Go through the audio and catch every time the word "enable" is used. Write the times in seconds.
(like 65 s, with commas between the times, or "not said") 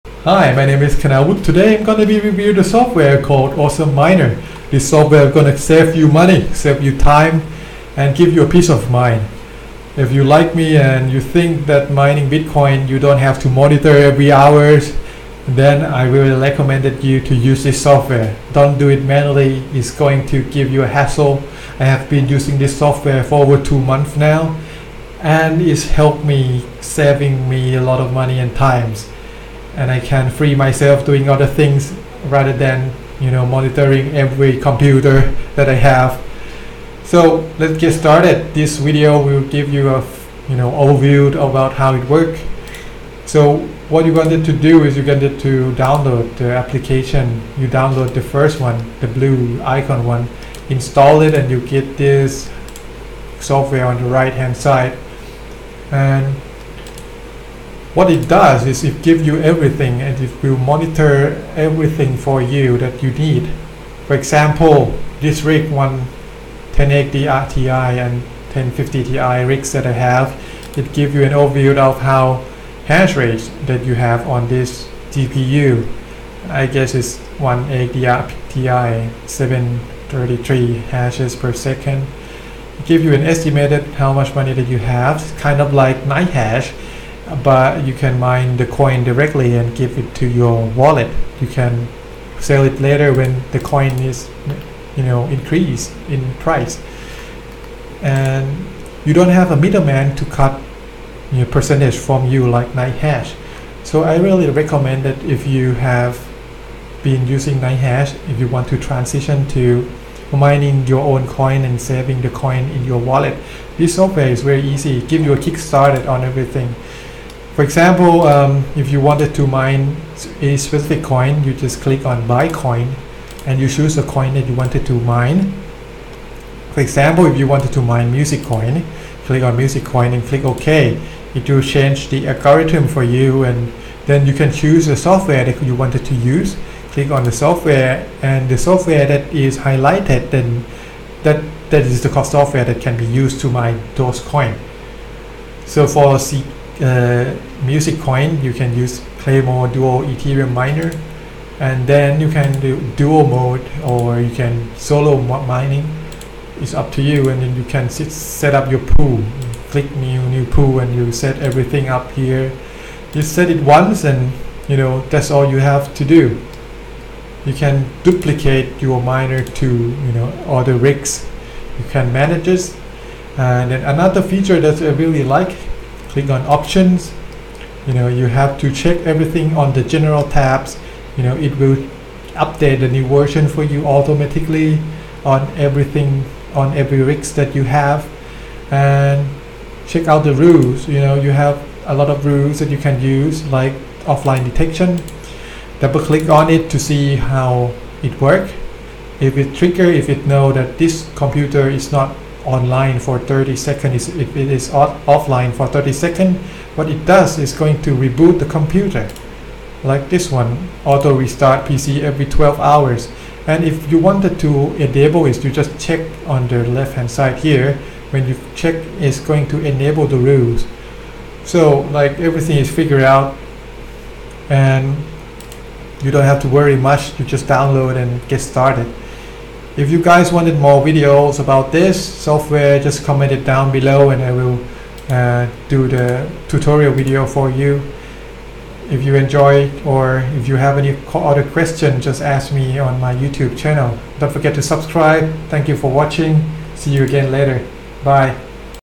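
214 s, 219 s.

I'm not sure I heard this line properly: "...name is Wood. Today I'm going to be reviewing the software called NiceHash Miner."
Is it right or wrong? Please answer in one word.
wrong.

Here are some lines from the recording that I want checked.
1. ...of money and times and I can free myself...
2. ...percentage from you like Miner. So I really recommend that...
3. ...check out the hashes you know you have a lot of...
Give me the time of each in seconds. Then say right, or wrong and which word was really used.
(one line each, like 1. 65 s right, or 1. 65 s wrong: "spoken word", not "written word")
1. 27 s right
2. 101 s wrong: "NiceHash", not "Miner"
3. 189 s wrong: "rules", not "hashes".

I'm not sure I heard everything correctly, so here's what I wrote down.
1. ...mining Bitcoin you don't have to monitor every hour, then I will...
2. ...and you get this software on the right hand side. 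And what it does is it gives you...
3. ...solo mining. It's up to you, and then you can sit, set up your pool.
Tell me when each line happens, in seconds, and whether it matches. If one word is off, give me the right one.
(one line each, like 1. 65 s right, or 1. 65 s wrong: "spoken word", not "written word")
1. 11 s right
2. 51 s right
3. 154 s right.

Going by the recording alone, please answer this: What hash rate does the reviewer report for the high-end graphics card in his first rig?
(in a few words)
733 hashes per second.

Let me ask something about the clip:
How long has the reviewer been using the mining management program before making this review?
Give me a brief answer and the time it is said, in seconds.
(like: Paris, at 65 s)
over two months, at 23 s.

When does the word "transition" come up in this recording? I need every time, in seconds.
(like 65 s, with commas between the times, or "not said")
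108 s.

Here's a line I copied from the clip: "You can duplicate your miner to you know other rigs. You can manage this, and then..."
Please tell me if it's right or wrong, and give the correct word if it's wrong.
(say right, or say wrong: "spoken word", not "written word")
right.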